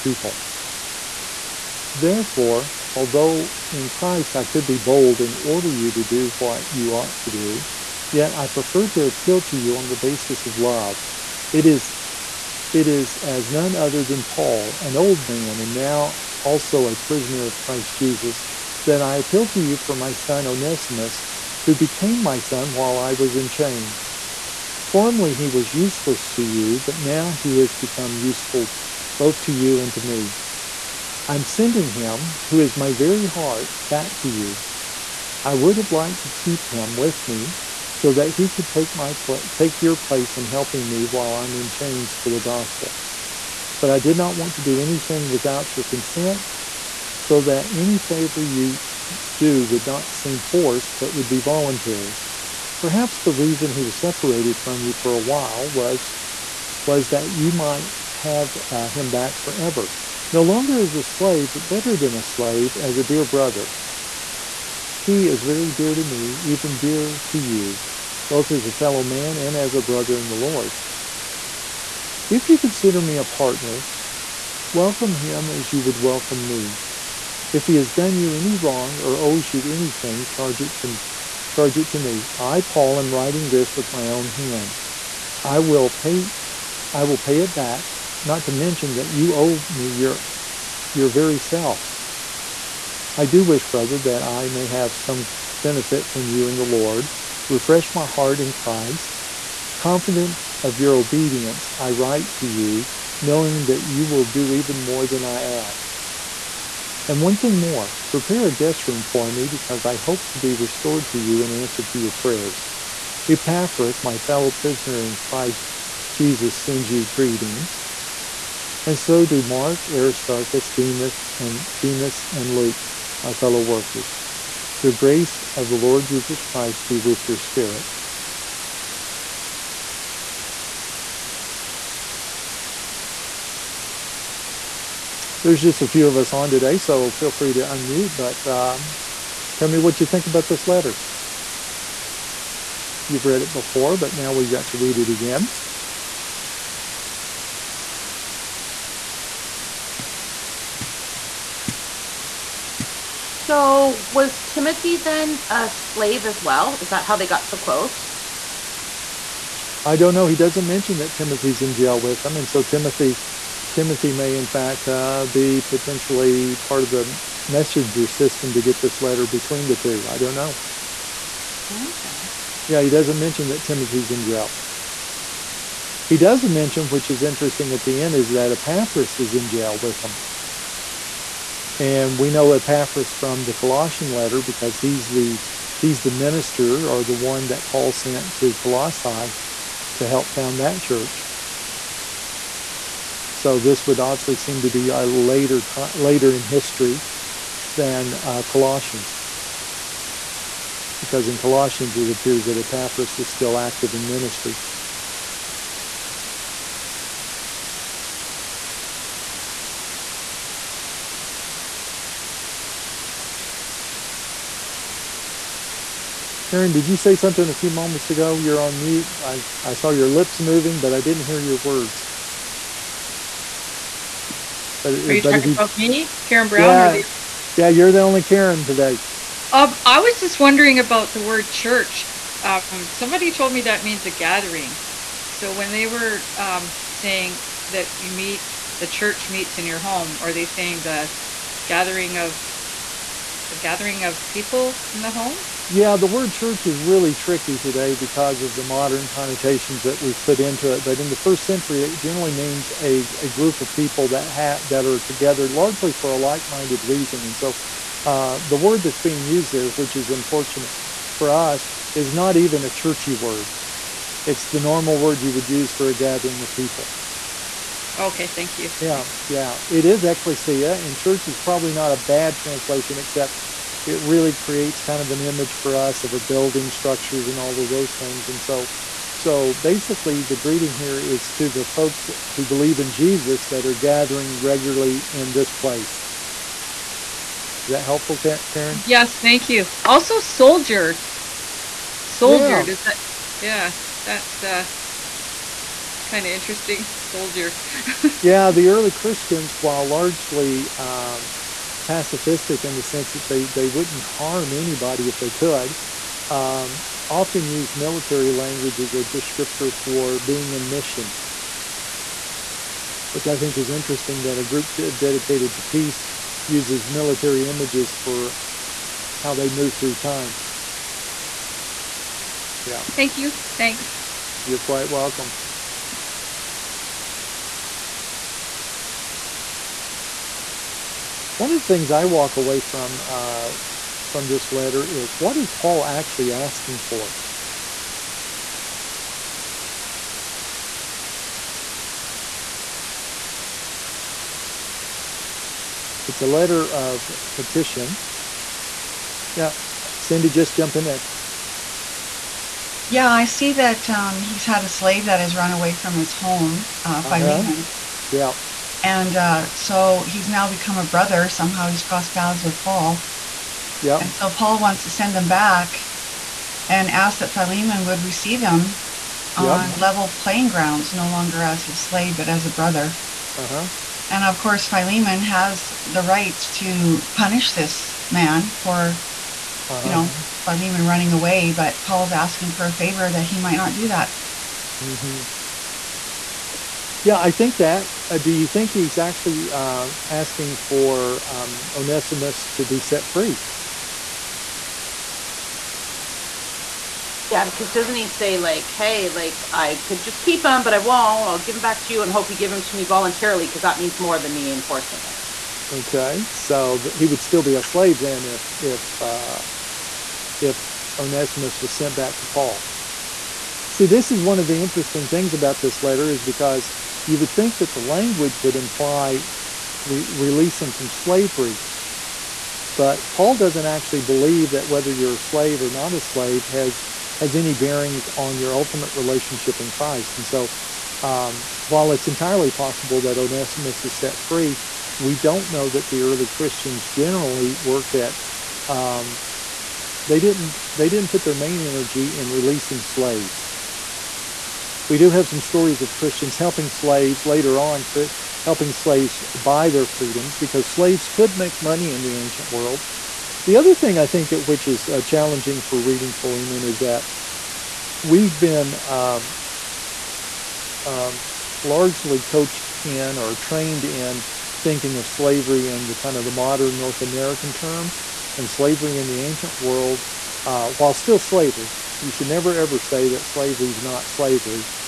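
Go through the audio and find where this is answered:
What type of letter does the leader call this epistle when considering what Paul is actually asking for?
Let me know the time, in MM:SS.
05:46.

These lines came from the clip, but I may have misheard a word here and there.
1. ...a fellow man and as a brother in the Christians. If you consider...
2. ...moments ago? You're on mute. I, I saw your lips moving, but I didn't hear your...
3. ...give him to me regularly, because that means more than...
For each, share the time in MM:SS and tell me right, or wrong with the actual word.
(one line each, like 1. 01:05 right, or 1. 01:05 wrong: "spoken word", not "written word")
1. 01:08 wrong: "Lord", not "Christians"
2. 03:37 right
3. 06:42 wrong: "voluntarily", not "regularly".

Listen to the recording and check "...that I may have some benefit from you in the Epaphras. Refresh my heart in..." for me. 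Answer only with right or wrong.
wrong.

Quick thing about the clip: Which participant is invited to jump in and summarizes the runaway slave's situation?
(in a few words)
Cindy.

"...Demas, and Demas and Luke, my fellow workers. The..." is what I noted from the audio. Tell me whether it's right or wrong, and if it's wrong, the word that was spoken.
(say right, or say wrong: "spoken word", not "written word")
right.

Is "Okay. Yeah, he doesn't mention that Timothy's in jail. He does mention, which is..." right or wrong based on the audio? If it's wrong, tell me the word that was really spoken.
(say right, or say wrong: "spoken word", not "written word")
right.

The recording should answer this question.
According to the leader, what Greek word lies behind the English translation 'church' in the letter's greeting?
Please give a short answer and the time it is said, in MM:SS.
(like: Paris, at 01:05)
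ecclesia, at 04:30.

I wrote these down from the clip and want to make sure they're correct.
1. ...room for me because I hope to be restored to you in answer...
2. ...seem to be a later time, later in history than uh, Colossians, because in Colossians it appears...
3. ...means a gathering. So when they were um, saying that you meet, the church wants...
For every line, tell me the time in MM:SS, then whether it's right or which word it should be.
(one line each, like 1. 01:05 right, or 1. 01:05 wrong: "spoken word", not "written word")
1. 01:48 right
2. 03:14 right
3. 03:53 wrong: "meets", not "wants".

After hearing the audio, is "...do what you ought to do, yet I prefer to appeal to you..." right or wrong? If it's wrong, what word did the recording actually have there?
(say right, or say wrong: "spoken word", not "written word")
right.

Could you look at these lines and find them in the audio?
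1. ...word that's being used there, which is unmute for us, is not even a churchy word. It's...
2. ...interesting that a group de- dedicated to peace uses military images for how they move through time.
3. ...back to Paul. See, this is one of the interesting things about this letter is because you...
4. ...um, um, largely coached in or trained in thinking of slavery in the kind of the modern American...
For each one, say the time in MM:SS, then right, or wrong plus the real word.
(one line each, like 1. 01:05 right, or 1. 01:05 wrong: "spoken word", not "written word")
1. 04:18 wrong: "unfortunate", not "unmute"
2. 05:13 right
3. 06:51 right
4. 07:38 wrong: "North", not "American".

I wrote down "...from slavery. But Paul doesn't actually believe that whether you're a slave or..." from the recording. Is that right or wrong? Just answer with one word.
right.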